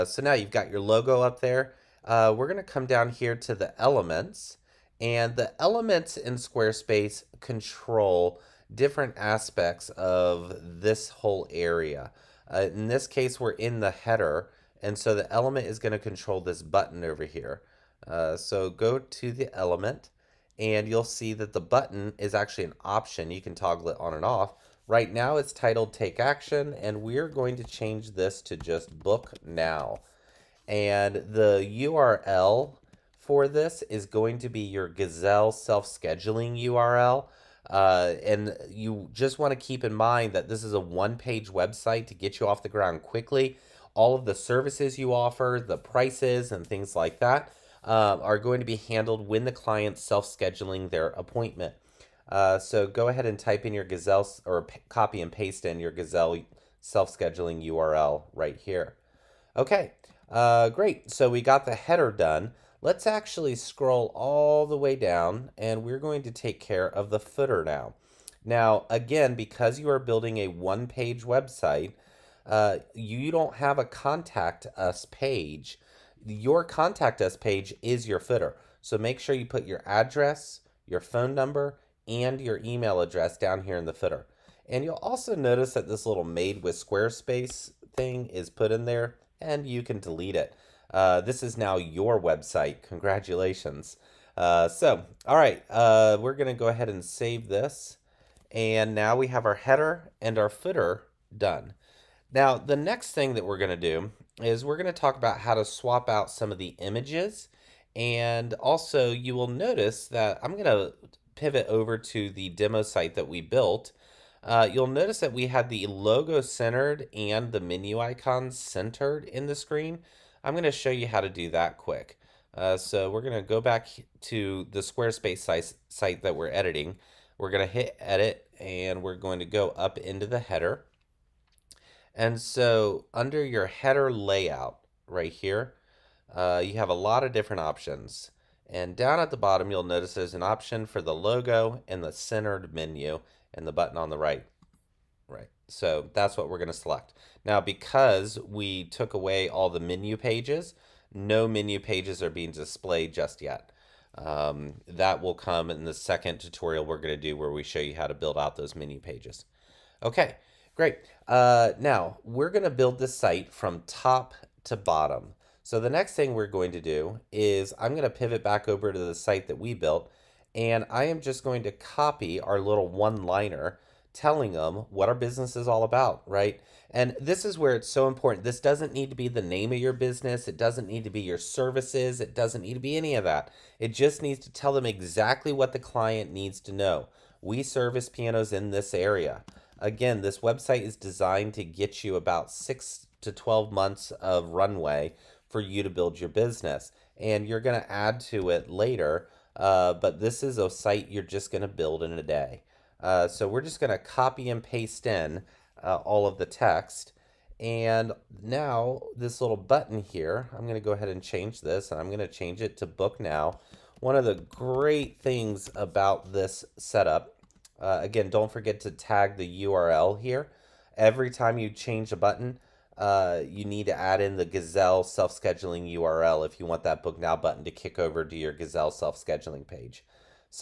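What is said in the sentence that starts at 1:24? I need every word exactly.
And you'll also notice that this little made with Squarespace thing is put in there and you can delete it.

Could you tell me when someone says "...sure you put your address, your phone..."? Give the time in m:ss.
1:19.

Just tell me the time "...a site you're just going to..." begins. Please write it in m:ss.
3:20.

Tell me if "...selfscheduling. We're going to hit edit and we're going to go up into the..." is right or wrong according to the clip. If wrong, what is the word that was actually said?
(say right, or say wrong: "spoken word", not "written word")
wrong: "editing", not "selfscheduling".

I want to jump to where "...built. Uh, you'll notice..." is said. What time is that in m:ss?
1:53.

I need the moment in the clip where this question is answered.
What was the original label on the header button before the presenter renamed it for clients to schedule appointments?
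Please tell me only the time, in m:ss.
0:25.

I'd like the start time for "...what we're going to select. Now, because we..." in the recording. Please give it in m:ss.
2:26.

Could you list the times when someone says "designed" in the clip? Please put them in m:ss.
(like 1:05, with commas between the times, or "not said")
3:10.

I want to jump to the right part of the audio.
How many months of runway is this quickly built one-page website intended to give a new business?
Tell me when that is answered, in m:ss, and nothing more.
3:12.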